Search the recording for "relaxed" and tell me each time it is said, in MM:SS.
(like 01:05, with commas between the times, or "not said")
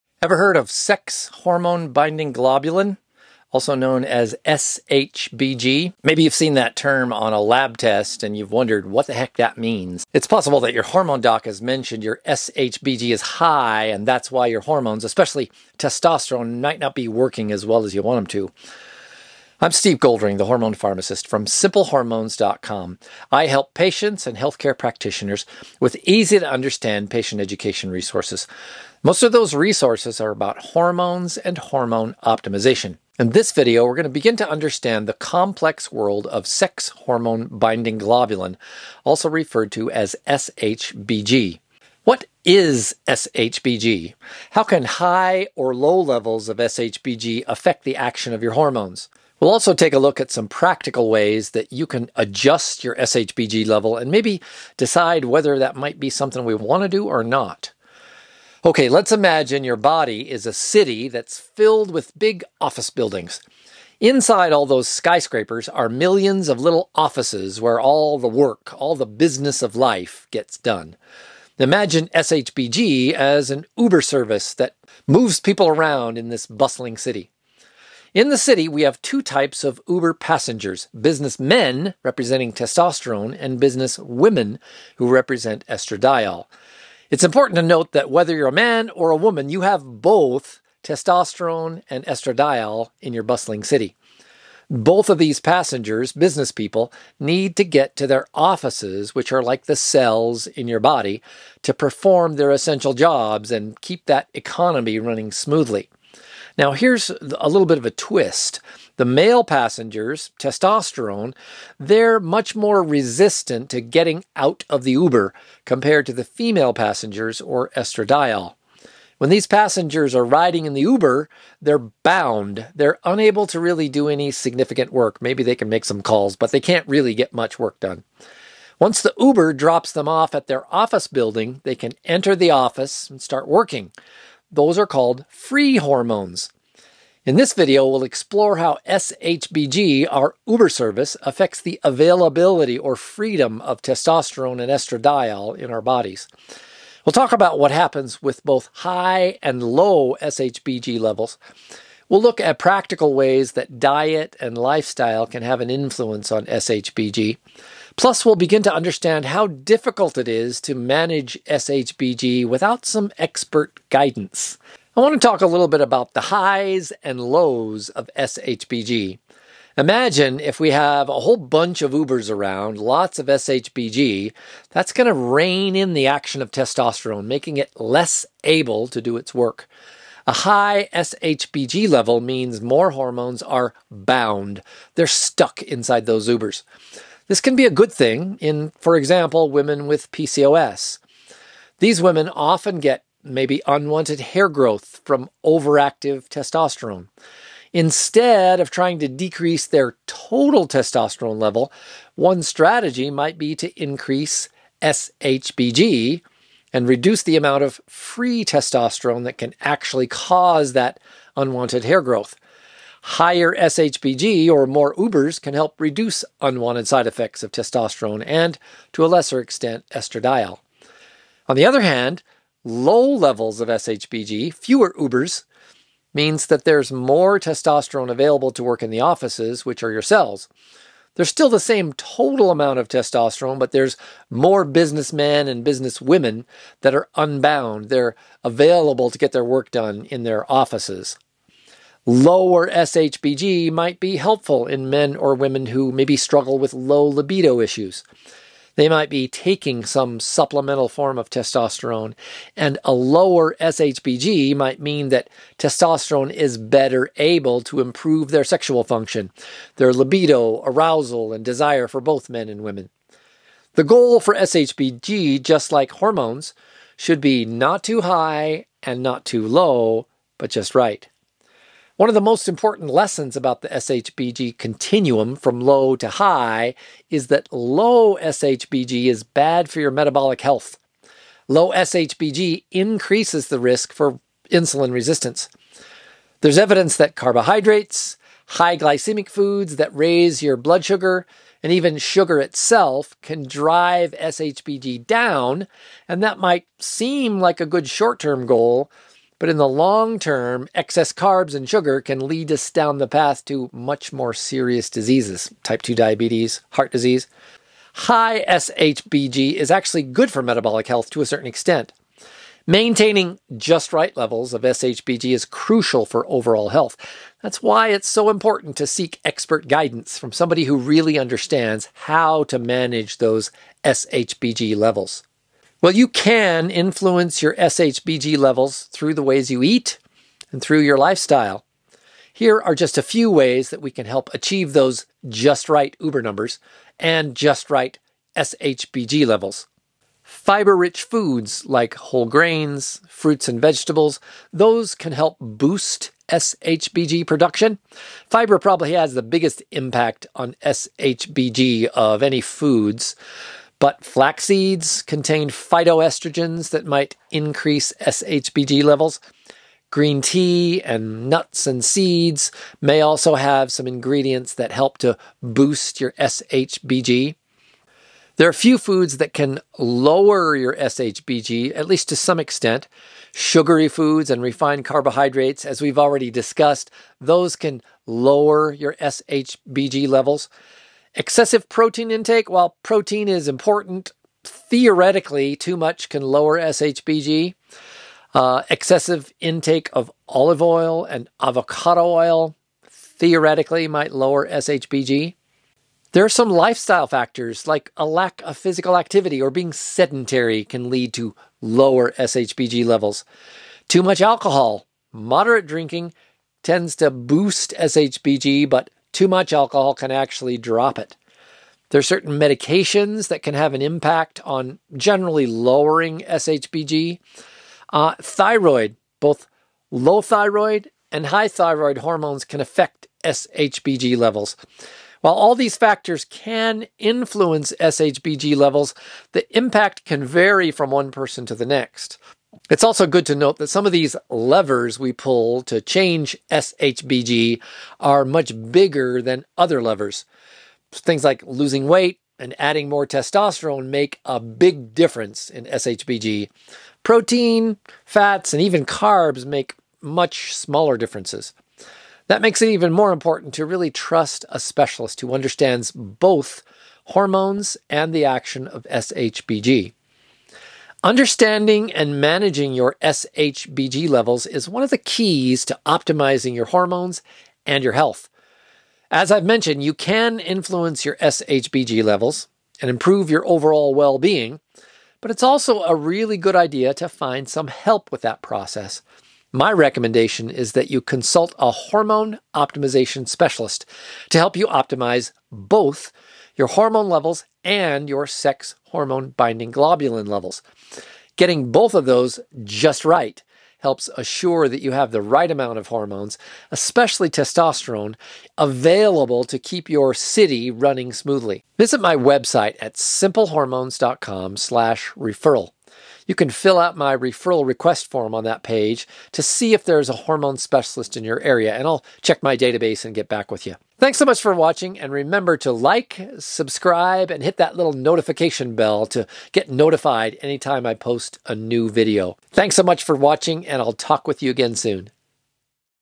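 not said.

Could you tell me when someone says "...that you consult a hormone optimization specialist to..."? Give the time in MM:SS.
08:00.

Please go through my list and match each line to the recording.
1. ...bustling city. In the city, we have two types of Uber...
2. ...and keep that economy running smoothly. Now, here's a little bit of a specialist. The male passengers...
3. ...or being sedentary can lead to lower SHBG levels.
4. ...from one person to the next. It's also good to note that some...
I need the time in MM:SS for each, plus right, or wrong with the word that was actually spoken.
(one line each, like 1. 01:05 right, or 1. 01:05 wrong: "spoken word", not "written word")
1. 01:16 right
2. 01:43 wrong: "twist", not "specialist"
3. 06:39 right
4. 07:10 right.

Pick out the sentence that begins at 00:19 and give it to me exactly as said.
I'm Steve Goldring, the hormone pharmacist from simplehormones.com.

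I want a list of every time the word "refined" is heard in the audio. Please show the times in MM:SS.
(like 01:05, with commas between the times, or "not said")
06:14.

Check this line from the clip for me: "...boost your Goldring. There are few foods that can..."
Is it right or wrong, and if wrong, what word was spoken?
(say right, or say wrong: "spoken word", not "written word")
wrong: "SHBG", not "Goldring".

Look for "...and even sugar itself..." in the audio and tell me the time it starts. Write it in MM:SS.
04:51.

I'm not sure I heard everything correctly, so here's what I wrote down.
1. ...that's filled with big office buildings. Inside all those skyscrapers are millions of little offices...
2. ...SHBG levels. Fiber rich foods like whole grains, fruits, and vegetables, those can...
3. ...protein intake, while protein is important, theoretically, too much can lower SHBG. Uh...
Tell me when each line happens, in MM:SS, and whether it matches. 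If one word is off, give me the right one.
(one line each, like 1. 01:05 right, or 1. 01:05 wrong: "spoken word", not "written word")
1. 01:01 right
2. 05:38 right
3. 06:21 right.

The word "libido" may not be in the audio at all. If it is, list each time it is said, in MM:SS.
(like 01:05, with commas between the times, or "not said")
04:07, 04:19.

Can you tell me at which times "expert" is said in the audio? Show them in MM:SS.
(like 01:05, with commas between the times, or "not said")
02:43, 05:19.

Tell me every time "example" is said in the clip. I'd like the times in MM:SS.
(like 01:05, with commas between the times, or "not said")
03:08.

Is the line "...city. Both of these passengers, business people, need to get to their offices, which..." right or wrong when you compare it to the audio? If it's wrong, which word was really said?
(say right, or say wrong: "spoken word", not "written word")
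right.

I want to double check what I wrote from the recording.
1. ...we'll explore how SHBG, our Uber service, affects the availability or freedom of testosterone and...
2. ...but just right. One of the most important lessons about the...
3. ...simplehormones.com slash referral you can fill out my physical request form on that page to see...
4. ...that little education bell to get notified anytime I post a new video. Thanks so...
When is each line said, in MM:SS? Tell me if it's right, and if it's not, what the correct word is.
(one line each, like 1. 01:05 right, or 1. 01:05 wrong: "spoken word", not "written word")
1. 02:17 right
2. 04:30 right
3. 08:22 wrong: "referral", not "physical"
4. 08:37 wrong: "notification", not "education".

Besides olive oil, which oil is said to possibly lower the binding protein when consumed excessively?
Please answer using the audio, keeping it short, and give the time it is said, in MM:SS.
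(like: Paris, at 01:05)
avocado oil, at 06:31.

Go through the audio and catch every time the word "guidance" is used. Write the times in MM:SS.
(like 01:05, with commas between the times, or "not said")
02:43, 05:19.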